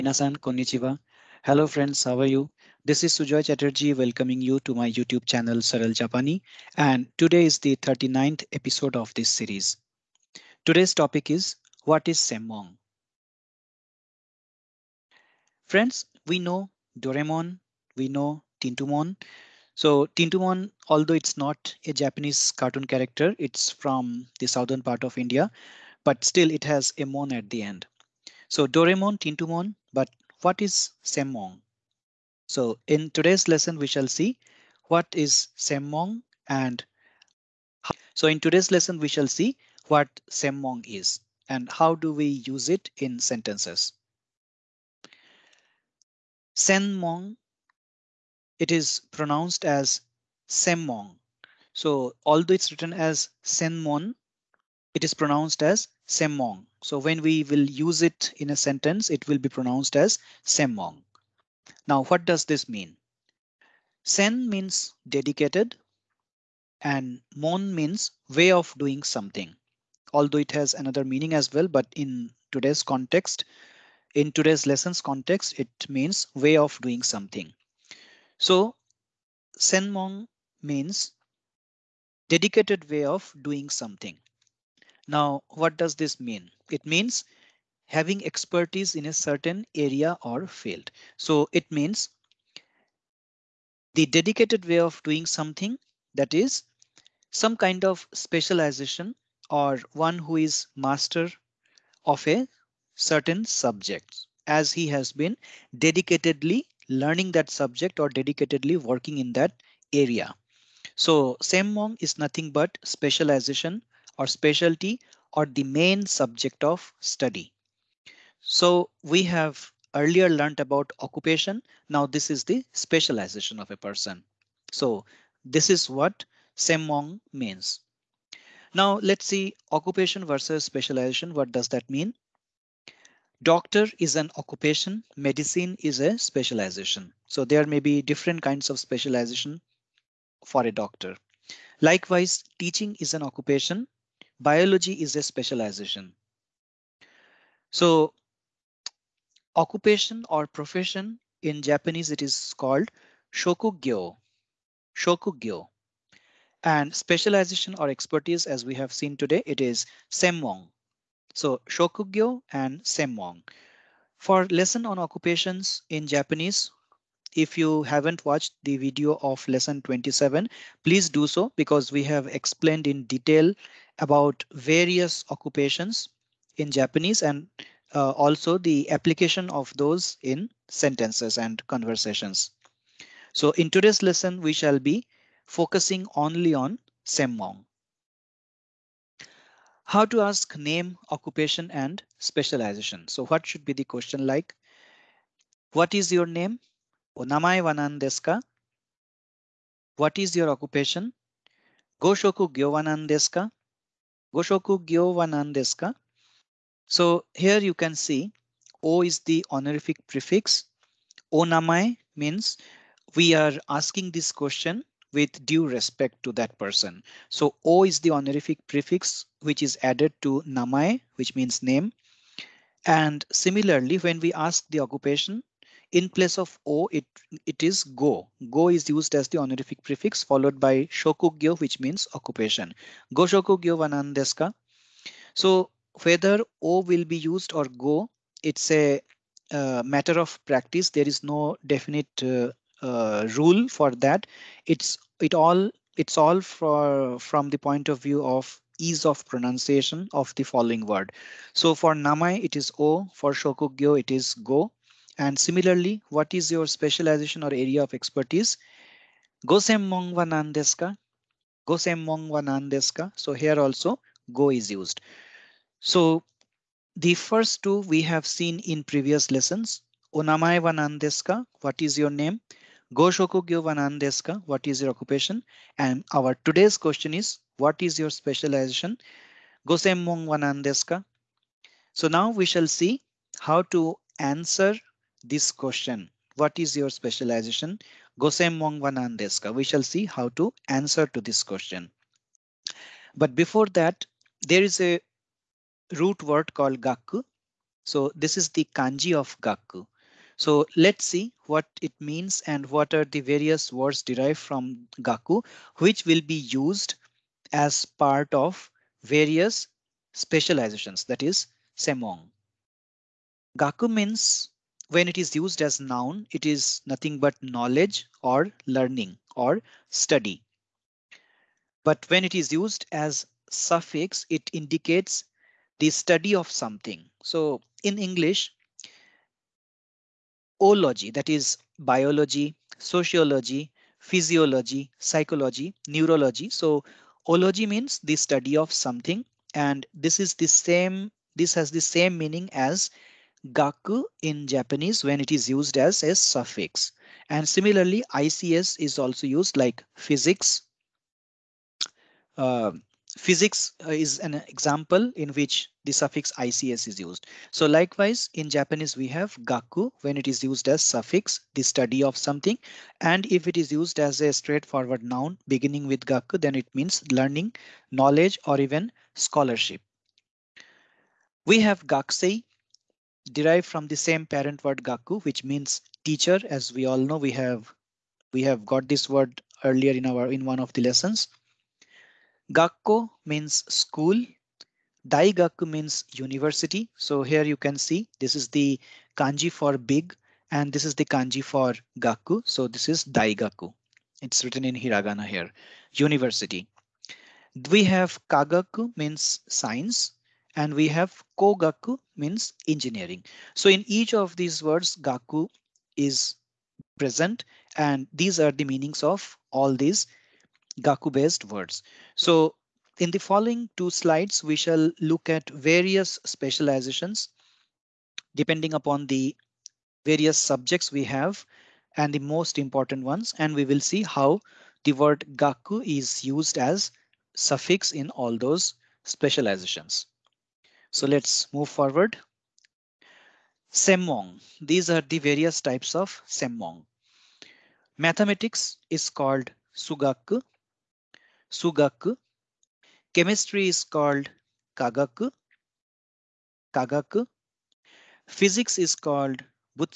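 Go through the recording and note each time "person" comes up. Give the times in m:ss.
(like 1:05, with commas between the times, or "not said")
2:03, 3:36.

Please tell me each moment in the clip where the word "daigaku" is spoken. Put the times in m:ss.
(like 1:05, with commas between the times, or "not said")
6:25, 6:33.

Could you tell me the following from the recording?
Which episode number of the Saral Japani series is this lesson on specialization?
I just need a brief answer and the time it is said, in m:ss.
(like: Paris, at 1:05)
39th, at 0:07.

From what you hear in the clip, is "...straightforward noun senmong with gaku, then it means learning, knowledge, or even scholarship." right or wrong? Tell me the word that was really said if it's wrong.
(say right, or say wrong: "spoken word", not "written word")
wrong: "beginning", not "senmong".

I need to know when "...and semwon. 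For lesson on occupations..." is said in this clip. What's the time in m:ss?
2:42.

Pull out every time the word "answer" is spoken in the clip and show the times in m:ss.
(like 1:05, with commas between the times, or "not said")
4:44, 4:50.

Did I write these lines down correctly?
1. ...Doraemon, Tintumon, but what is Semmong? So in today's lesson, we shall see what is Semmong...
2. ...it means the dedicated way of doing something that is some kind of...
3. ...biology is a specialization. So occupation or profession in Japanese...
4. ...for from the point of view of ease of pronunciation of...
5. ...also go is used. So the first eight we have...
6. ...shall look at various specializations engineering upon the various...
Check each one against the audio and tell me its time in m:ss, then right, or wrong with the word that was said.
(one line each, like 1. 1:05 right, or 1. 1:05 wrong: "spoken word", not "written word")
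1. 0:28 right
2. 1:31 right
3. 2:24 right
4. 4:06 right
5. 4:23 wrong: "two", not "eight"
6. 6:54 wrong: "depending", not "engineering".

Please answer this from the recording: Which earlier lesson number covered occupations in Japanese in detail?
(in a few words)
27.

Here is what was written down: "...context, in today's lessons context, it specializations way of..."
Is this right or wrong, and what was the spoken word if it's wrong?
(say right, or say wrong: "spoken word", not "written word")
wrong: "means", not "specializations".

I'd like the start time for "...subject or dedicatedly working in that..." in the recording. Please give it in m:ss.
1:47.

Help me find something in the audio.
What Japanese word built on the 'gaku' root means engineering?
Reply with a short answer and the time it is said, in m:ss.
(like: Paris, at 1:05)
kogaku, at 6:41.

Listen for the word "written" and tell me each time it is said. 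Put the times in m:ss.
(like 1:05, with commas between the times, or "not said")
0:52, 6:34.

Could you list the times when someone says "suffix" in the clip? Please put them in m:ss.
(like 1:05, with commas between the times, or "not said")
5:23, 5:46, 5:55, 6:00, 7:07.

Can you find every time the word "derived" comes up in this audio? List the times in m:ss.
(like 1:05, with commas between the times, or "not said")
5:04, 6:13.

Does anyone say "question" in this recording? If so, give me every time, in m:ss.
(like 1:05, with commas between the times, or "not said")
3:13, 3:34, 4:36, 4:45, 4:51.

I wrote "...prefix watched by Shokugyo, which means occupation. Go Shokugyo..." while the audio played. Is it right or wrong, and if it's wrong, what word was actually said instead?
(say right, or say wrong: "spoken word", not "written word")
wrong: "followed", not "watched".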